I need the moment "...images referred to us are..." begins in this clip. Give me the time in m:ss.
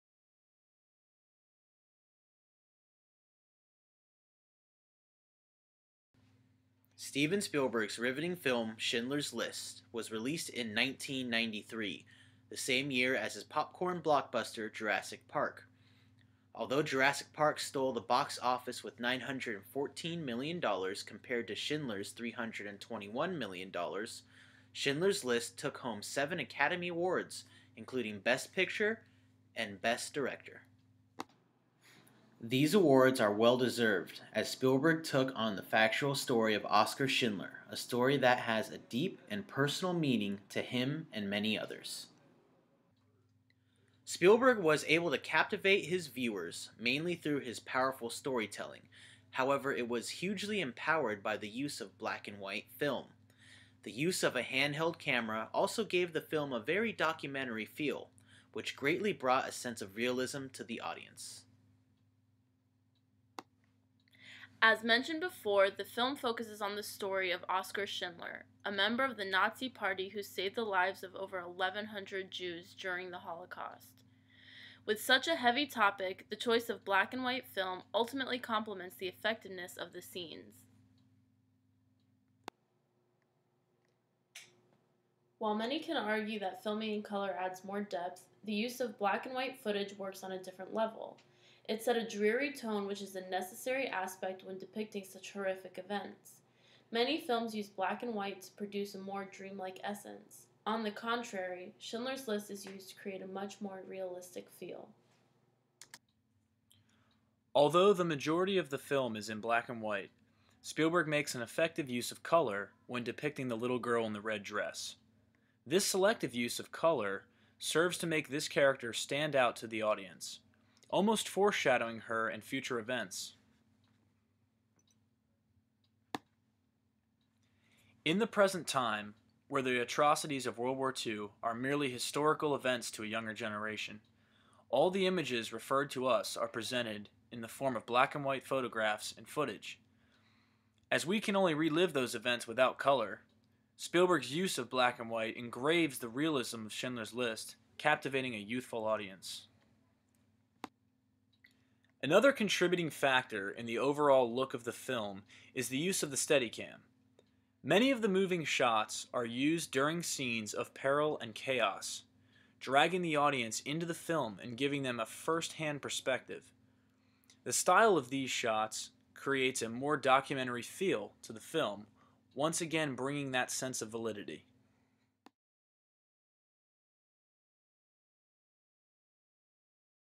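2:15.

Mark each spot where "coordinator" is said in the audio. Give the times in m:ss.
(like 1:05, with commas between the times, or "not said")
not said.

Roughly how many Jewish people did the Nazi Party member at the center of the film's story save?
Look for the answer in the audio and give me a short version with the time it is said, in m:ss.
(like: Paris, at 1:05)
over 1,100, at 1:11.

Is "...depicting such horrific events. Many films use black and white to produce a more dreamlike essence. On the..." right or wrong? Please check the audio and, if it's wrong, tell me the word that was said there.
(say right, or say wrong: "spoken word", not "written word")
right.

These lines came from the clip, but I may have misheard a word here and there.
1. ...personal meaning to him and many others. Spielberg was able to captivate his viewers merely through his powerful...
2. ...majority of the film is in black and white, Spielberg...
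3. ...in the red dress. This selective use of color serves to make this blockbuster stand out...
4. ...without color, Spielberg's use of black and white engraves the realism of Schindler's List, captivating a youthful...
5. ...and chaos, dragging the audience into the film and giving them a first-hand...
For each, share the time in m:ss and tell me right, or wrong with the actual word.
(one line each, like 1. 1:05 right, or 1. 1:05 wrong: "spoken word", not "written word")
1. 0:39 wrong: "mainly", not "merely"
2. 1:48 right
3. 1:54 wrong: "character", not "blockbuster"
4. 2:22 right
5. 2:41 right.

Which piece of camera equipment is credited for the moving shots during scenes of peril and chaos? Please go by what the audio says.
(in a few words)
Steadicam.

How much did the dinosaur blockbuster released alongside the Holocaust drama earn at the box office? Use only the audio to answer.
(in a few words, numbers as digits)
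$914 million.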